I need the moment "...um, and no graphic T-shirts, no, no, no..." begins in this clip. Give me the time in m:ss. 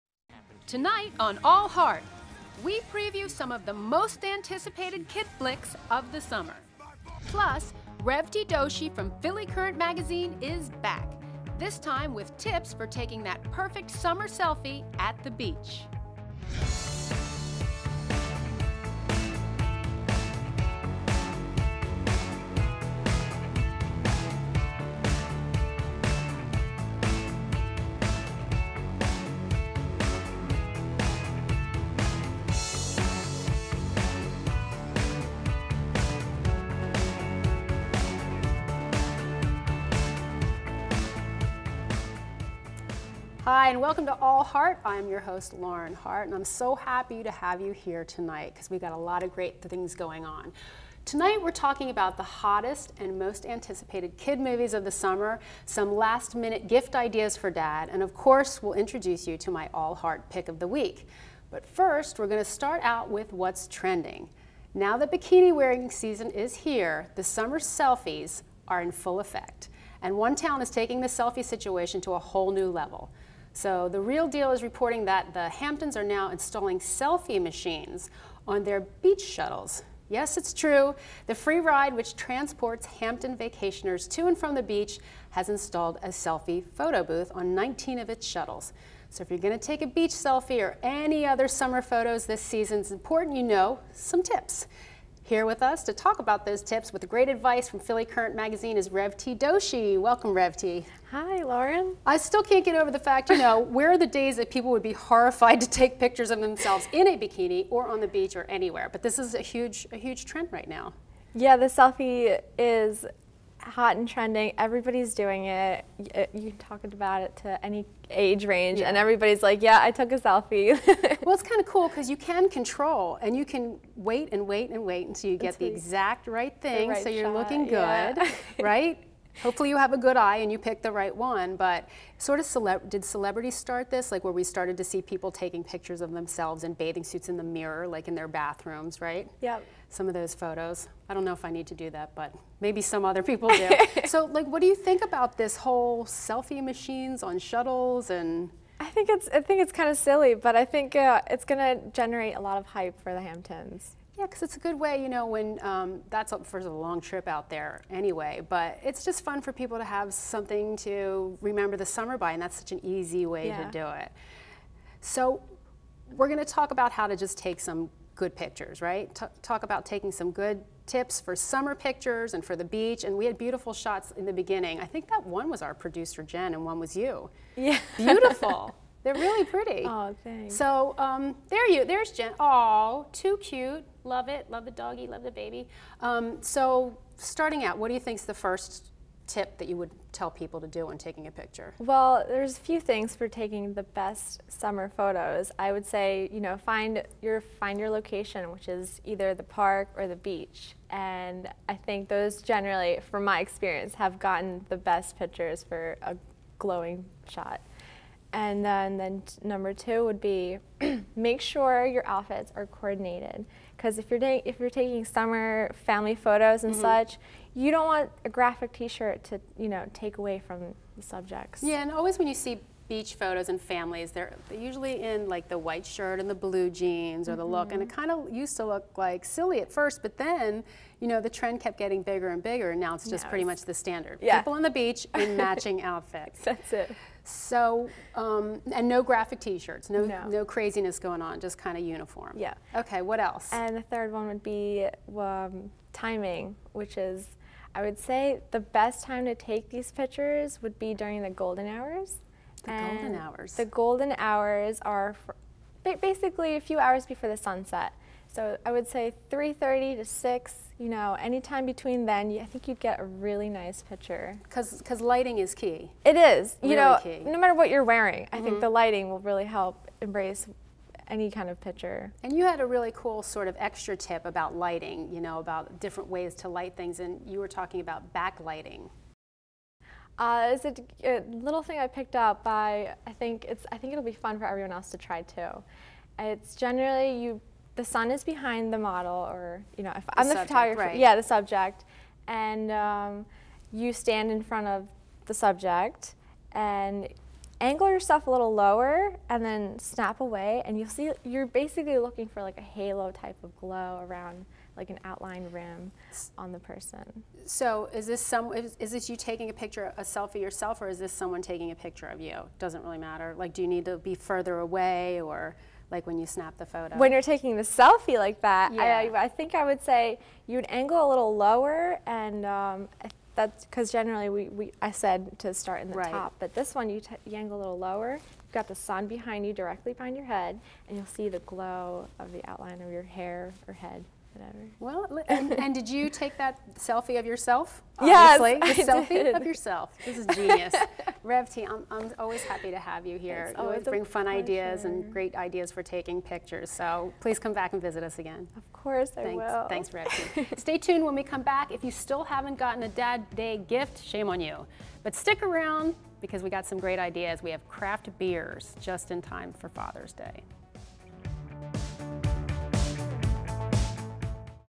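3:58.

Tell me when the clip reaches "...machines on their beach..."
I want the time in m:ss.
1:17.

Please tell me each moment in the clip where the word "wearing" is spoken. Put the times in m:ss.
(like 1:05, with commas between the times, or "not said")
1:05, 4:27.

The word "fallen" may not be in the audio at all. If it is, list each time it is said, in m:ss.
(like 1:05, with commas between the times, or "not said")
not said.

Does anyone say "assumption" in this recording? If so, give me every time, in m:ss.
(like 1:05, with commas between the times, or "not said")
not said.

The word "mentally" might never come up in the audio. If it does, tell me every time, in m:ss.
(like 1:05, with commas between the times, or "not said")
not said.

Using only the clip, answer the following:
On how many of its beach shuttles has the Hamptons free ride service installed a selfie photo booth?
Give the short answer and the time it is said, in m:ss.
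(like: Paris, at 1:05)
19, at 1:27.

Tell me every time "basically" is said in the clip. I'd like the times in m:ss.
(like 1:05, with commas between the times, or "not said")
4:16, 5:01.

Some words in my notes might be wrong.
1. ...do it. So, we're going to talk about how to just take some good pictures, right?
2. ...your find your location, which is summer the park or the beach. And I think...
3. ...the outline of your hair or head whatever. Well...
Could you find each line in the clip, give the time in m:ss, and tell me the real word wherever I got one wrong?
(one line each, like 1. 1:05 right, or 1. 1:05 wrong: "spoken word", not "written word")
1. 2:43 right
2. 3:17 wrong: "either", not "summer"
3. 5:32 right.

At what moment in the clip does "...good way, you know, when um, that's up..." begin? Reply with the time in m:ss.
2:34.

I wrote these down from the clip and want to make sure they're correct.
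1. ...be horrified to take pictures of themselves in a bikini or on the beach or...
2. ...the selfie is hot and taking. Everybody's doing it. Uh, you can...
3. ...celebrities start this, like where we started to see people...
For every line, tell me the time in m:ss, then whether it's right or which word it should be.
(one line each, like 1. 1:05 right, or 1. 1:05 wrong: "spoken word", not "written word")
1. 1:44 right
2. 1:51 wrong: "trending", not "taking"
3. 2:13 right.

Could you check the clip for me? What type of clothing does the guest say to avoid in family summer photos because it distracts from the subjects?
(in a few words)
graphic T-shirt.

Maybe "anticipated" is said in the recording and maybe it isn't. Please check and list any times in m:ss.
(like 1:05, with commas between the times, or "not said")
0:04, 0:53.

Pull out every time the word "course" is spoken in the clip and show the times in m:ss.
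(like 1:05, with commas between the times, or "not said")
0:58, 5:48.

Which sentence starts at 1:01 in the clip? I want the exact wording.
But first, we're going to start out with what's trending.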